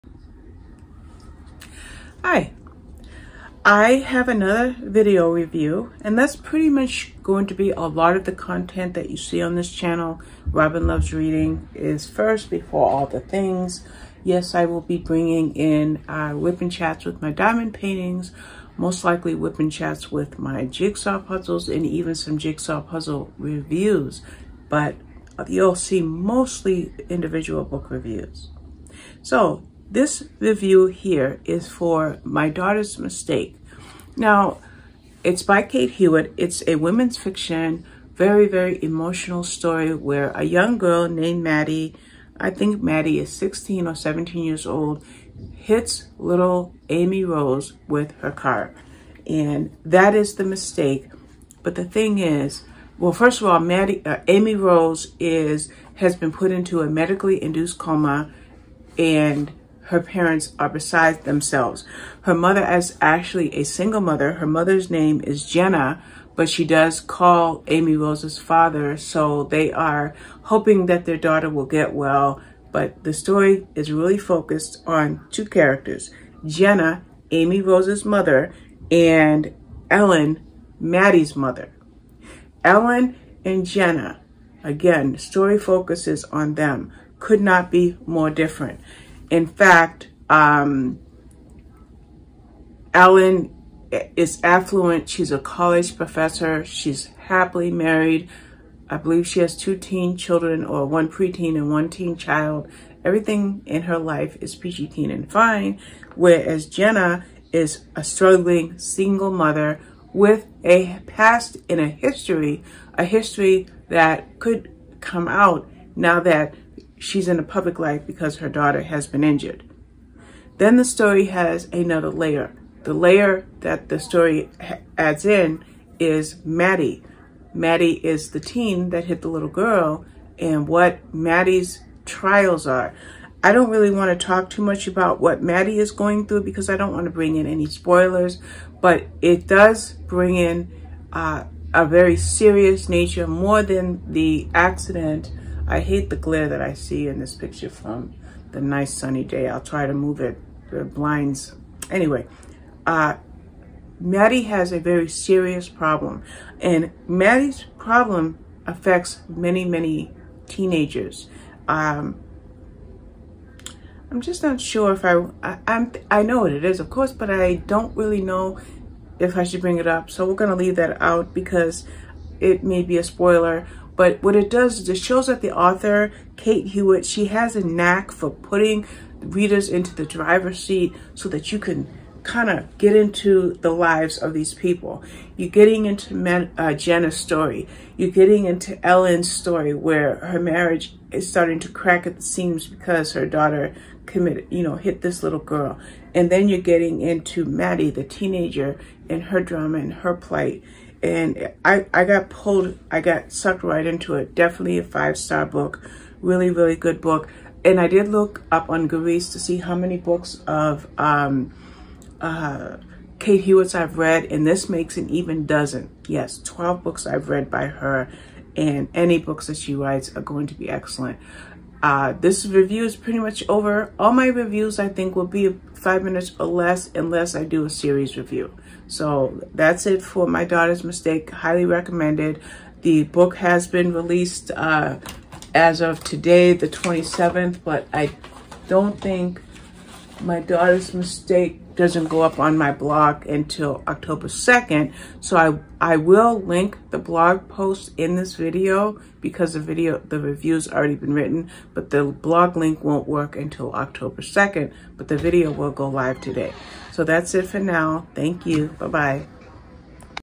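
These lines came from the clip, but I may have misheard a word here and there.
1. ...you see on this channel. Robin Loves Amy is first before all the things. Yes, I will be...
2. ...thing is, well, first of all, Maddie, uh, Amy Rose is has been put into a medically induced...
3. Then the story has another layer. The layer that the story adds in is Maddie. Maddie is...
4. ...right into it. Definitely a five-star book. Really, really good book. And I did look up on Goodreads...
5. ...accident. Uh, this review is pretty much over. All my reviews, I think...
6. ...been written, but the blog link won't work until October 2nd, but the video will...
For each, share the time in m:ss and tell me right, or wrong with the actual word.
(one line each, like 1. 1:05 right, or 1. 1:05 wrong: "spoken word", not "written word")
1. 0:09 wrong: "Reading", not "Amy"
2. 0:51 right
3. 2:00 right
4. 3:23 right
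5. 3:40 wrong: "excellent", not "accident"
6. 4:10 right.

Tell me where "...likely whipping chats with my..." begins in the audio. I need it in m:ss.
0:19.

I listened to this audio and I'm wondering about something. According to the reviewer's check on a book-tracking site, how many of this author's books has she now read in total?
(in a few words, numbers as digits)
12.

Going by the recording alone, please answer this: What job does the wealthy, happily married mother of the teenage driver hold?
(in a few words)
College professor.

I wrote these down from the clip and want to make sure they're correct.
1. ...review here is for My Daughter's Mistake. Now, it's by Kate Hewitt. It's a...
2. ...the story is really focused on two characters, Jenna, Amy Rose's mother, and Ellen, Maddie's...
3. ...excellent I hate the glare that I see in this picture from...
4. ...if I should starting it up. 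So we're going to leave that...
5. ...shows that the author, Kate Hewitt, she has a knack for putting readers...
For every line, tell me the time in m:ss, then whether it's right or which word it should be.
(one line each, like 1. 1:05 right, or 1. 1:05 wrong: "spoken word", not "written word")
1. 0:30 right
2. 1:13 right
3. 2:24 wrong: "accident", not "excellent"
4. 2:49 wrong: "bring", not "starting"
5. 2:54 right.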